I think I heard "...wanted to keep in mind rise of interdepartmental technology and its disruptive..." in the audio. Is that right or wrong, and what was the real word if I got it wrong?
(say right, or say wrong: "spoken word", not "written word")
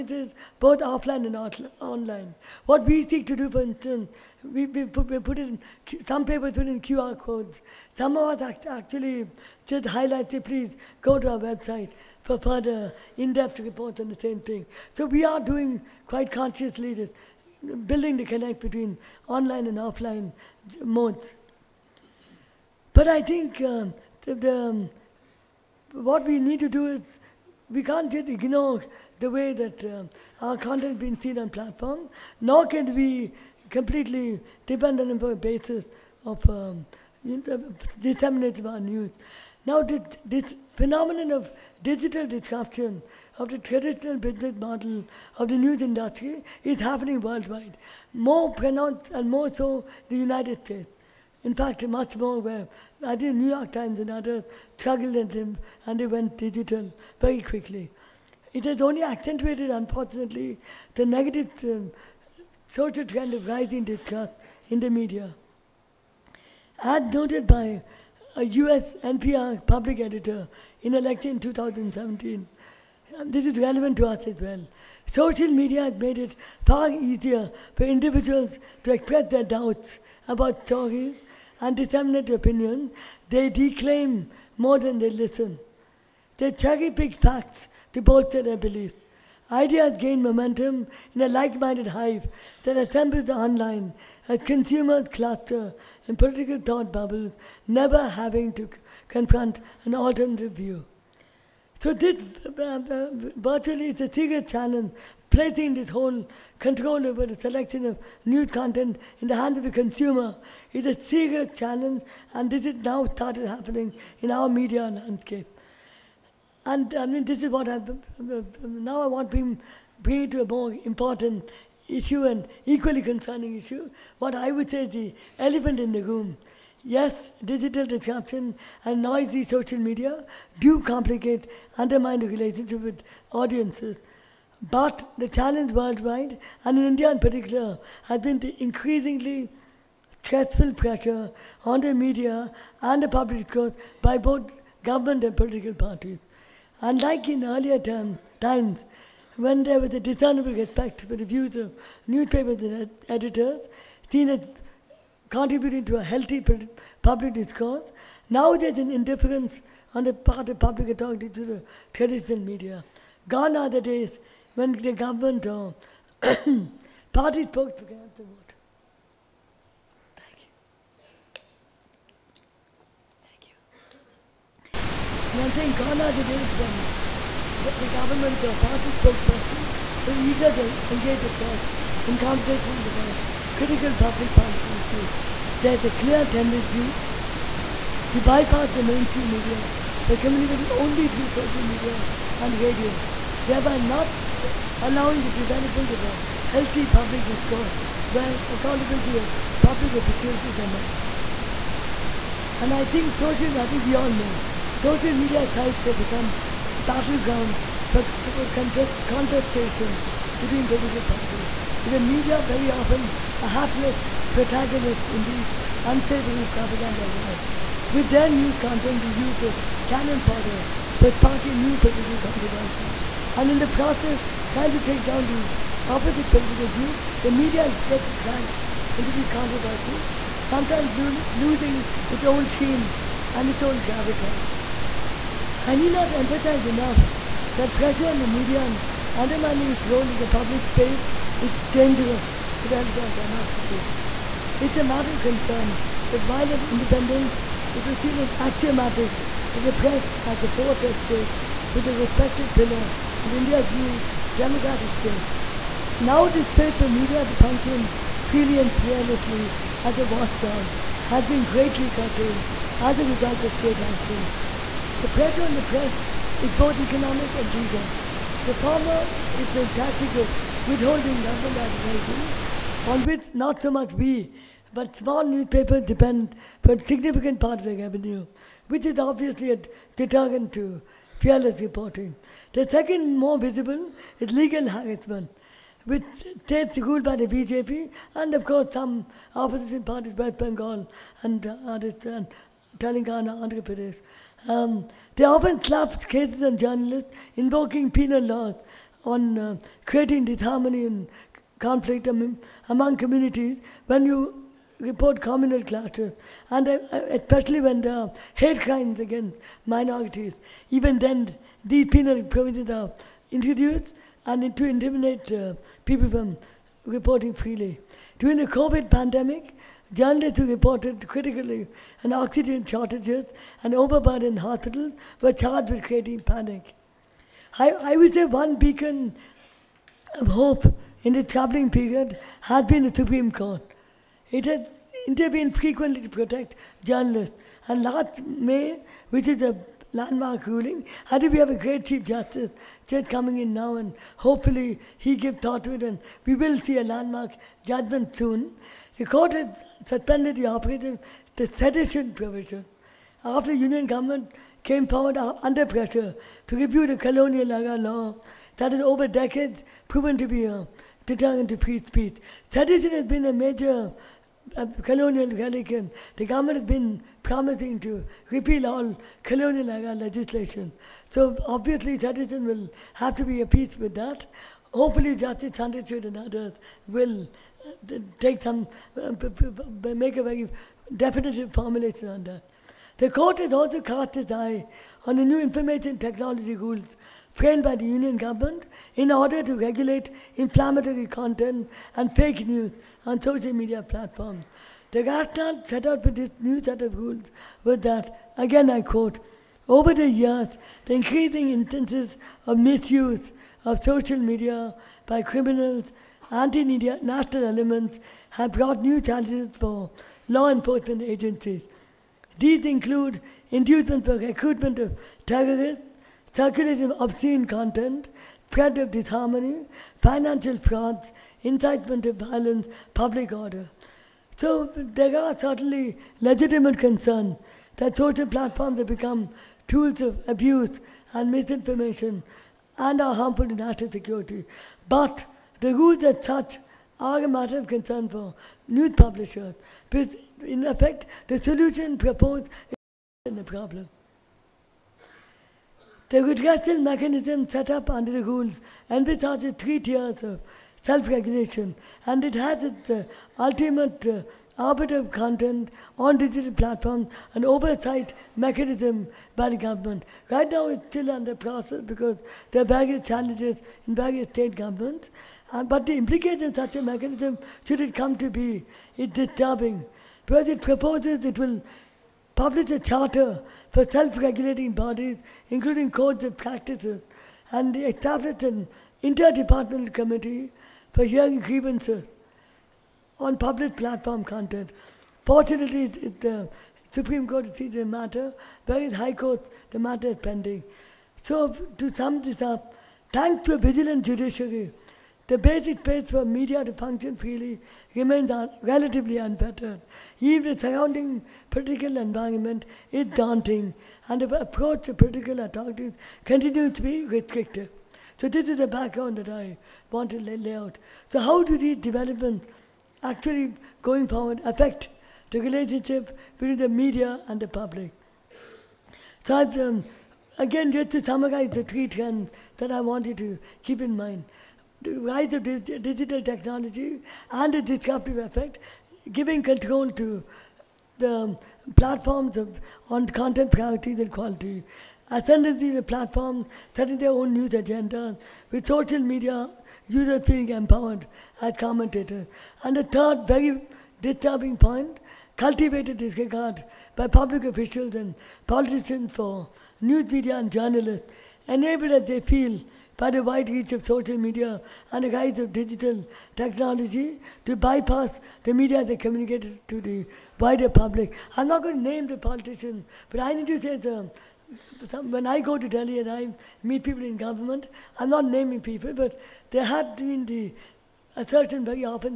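wrong: "digital", not "interdepartmental".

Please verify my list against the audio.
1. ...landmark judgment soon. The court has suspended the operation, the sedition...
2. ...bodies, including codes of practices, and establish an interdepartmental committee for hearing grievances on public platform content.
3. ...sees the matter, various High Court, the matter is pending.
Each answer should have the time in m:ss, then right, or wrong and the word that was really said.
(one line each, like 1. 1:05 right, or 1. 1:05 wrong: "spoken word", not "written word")
1. 5:46 right
2. 7:54 right
3. 8:07 right.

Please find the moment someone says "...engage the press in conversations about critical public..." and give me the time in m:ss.
3:00.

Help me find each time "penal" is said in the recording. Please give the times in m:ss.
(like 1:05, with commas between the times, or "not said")
4:57, 5:11.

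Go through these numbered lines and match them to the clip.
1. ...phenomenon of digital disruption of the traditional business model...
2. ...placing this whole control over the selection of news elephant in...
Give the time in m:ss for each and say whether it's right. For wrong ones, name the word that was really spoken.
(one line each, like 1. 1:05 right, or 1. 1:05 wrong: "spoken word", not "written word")
1. 0:40 right
2. 1:45 wrong: "content", not "elephant".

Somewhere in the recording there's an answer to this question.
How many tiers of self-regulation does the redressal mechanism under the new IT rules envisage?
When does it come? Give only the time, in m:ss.
7:29.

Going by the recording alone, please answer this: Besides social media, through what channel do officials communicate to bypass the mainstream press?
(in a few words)
Radio.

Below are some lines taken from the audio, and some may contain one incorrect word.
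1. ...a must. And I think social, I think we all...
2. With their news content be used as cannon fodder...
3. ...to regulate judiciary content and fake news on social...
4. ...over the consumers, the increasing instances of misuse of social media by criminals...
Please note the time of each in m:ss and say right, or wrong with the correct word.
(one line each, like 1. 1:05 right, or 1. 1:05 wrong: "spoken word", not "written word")
1. 3:20 right
2. 3:37 right
3. 6:29 wrong: "inflammatory", not "judiciary"
4. 6:39 wrong: "years", not "consumers".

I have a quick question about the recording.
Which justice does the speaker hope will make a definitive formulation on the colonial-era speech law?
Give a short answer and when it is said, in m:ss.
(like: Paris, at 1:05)
Justice Chandrachud, at 6:15.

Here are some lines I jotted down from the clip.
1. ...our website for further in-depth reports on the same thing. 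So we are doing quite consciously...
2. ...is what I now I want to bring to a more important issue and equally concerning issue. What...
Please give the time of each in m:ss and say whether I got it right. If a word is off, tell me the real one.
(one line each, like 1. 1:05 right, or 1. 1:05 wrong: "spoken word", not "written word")
1. 0:11 right
2. 1:57 right.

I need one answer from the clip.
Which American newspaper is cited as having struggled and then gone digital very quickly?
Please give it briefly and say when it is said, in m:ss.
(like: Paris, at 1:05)
New York Times, at 0:53.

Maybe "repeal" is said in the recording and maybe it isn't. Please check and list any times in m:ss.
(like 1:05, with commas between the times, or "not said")
6:08.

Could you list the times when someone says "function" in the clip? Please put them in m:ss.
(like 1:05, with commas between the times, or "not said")
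4:17, 8:16.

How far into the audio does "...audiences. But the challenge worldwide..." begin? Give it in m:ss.
2:13.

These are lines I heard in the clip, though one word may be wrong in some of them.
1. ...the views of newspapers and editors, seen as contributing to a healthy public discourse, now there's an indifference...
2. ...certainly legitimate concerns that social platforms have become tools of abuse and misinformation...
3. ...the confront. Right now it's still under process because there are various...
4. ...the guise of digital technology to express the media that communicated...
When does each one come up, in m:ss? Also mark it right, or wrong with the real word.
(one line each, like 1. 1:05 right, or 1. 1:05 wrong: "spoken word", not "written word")
1. 2:31 right
2. 7:05 right
3. 7:39 wrong: "government", not "confront"
4. 9:15 wrong: "bypass", not "express".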